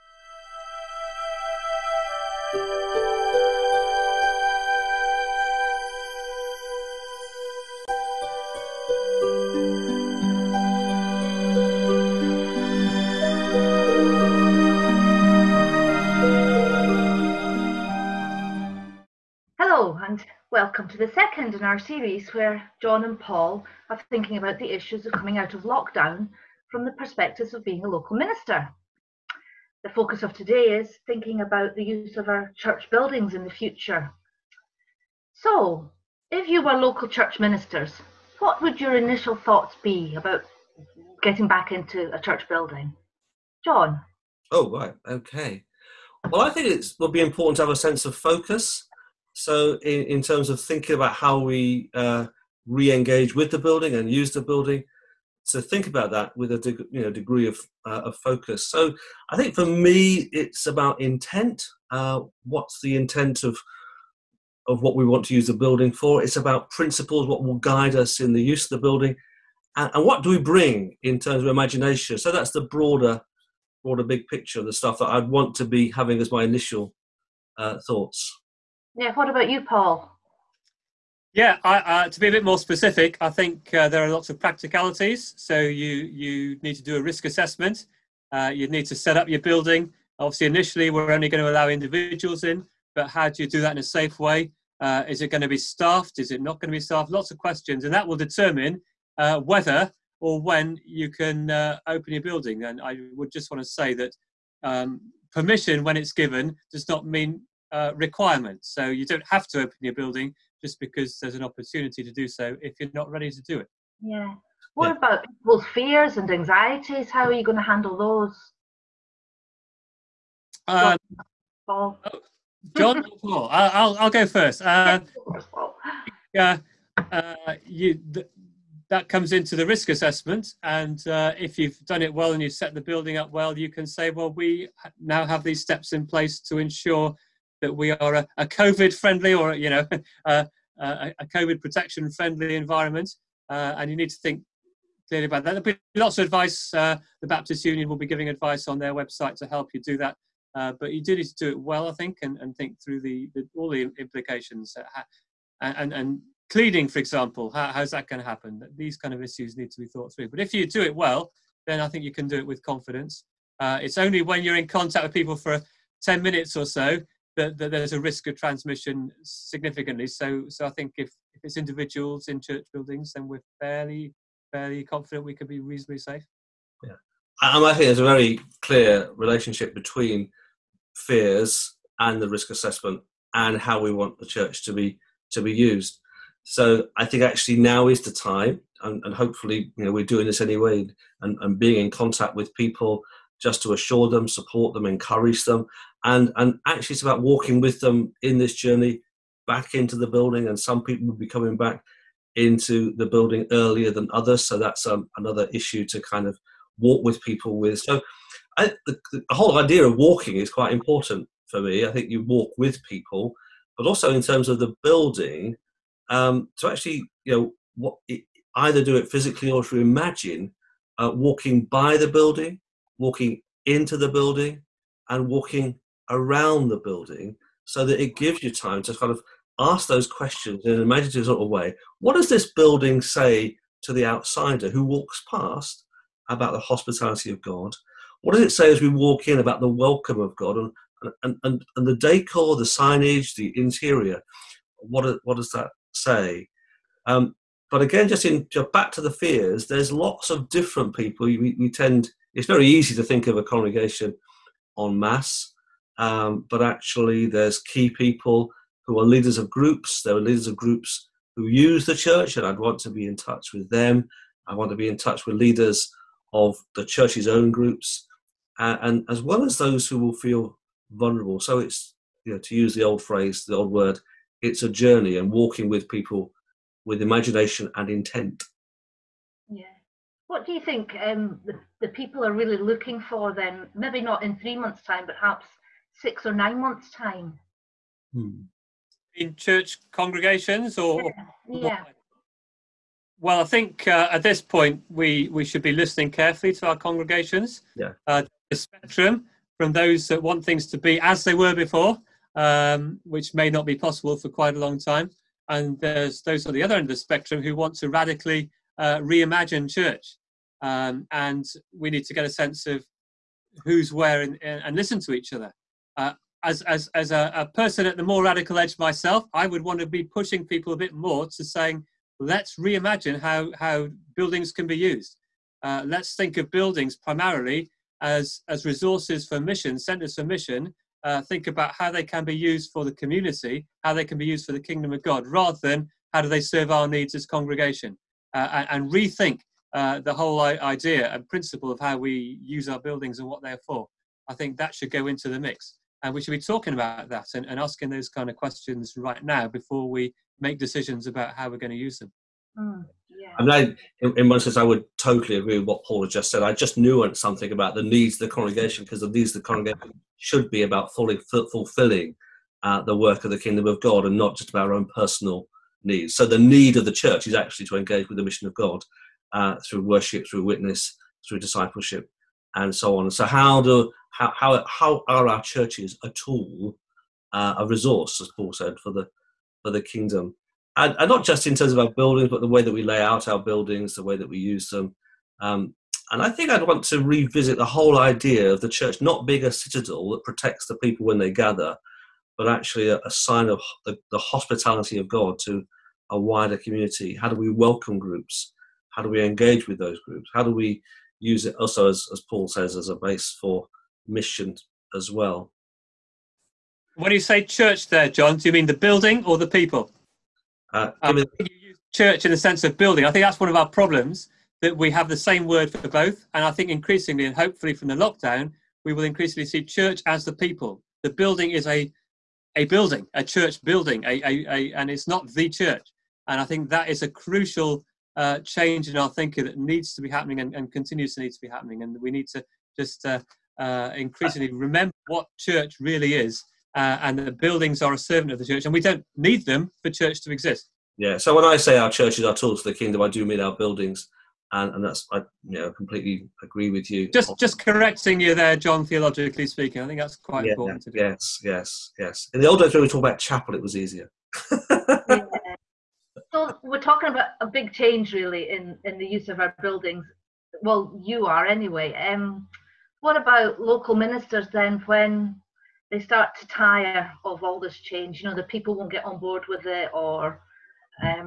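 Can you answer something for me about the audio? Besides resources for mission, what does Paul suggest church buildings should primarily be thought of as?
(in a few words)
centers for mission.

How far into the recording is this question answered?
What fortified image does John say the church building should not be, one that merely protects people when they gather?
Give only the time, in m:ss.
6:29.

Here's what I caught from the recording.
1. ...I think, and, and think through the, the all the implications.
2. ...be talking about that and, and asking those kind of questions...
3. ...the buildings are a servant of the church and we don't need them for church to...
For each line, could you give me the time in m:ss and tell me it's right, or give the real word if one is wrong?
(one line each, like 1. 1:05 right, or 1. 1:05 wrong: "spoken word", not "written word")
1. 2:31 right
2. 5:46 right
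3. 7:17 right.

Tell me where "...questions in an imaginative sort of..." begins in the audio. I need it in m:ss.
3:50.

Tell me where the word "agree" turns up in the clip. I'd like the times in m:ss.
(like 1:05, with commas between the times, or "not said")
5:55, 7:26.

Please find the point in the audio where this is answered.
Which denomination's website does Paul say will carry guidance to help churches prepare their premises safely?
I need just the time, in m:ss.
2:27.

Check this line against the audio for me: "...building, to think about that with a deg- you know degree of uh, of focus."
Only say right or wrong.
right.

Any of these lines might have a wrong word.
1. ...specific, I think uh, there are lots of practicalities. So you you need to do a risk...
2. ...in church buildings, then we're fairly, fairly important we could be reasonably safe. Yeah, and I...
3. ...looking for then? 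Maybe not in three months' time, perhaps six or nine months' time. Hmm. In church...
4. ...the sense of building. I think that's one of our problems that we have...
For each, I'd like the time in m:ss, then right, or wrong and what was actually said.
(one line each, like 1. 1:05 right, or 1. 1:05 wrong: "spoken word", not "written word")
1. 1:22 right
2. 2:52 wrong: "confident", not "important"
3. 4:42 right
4. 6:52 right.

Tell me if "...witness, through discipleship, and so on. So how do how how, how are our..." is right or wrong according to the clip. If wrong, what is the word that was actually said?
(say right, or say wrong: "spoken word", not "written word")
right.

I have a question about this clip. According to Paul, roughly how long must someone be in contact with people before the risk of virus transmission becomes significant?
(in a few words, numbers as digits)
10 minutes.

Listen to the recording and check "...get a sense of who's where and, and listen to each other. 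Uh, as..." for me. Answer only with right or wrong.
right.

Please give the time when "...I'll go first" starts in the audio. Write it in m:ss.
2:04.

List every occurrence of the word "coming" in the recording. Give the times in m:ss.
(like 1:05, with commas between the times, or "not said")
0:25, 3:21.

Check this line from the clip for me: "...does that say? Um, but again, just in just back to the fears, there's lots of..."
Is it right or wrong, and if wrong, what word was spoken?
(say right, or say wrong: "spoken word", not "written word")
right.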